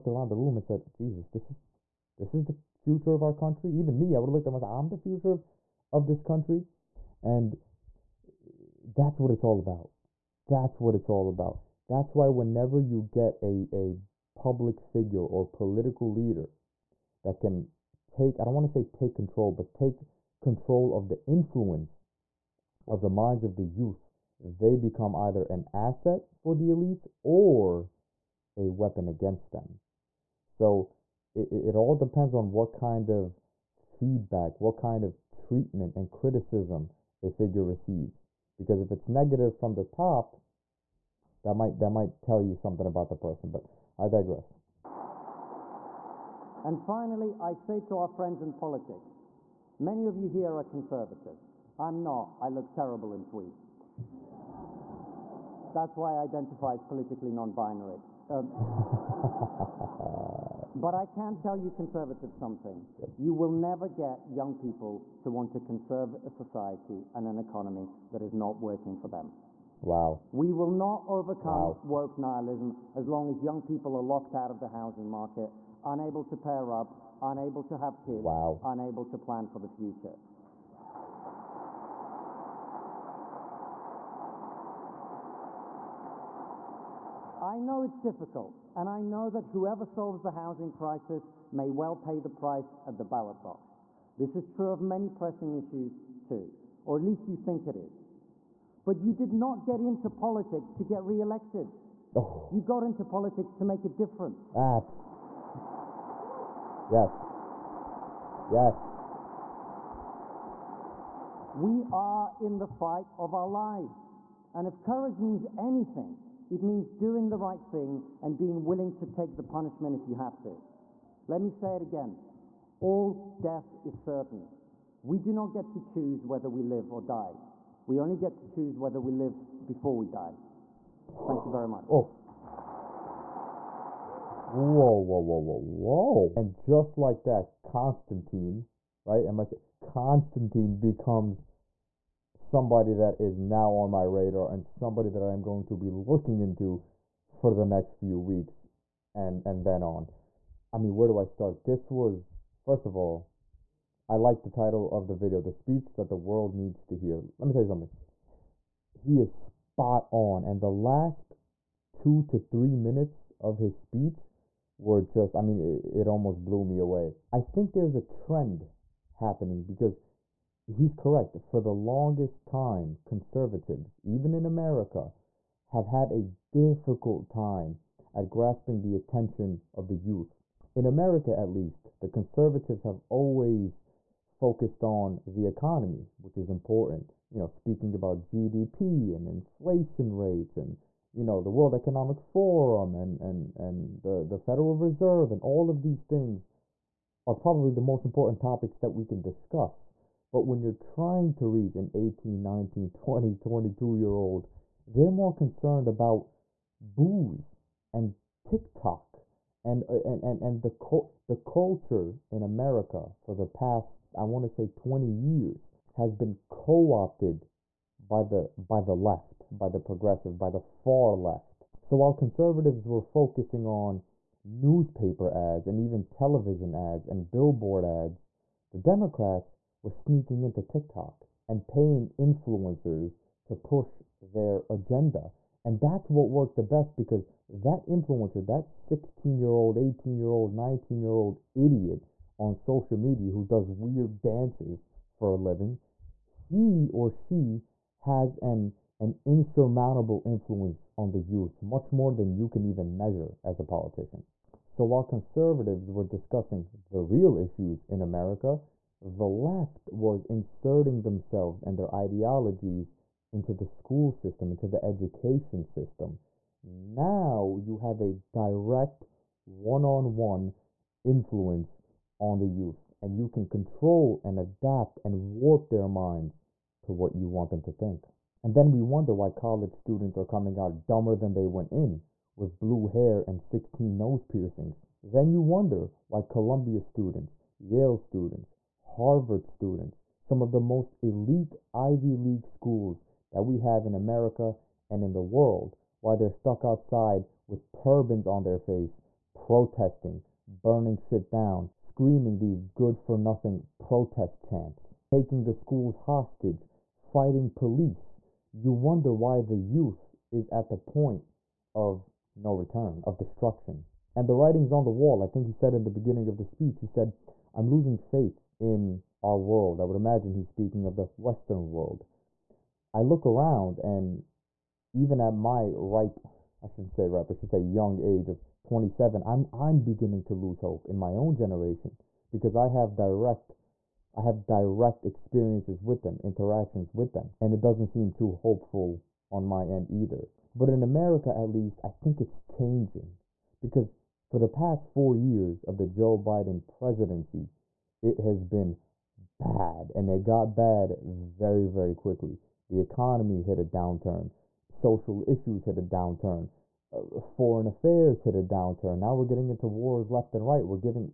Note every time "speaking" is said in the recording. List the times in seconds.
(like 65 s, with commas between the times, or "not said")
187 s, 320 s.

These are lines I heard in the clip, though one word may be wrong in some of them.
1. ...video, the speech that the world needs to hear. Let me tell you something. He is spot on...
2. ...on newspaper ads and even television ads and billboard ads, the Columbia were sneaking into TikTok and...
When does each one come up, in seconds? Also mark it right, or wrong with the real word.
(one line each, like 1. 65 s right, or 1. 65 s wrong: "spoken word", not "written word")
1. 155 s right
2. 223 s wrong: "Democrats", not "Columbia".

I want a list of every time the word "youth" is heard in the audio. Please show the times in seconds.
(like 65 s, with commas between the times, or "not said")
23 s, 179 s, 251 s, 272 s, 309 s.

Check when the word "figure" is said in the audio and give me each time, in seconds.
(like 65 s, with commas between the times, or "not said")
14 s, 37 s.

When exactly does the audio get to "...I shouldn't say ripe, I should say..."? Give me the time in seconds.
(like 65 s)
326 s.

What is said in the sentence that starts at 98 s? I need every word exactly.
But you did not get into politics to get re-elected.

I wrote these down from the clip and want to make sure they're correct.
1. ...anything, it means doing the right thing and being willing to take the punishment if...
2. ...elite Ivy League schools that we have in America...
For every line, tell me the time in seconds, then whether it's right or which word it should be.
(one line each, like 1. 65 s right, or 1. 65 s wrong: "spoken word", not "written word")
1. 115 s right
2. 291 s right.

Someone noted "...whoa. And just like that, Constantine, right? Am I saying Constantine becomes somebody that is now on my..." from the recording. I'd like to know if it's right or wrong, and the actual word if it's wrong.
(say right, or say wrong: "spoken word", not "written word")
right.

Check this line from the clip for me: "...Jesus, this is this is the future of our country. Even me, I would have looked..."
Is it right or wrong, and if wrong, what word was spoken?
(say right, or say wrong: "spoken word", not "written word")
right.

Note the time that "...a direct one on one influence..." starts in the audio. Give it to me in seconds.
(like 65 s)
268 s.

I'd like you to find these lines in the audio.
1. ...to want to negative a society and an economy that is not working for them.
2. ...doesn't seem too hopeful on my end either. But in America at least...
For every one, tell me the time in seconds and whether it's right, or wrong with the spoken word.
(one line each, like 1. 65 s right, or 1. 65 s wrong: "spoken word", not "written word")
1. 65 s wrong: "conserve", not "negative"
2. 337 s right.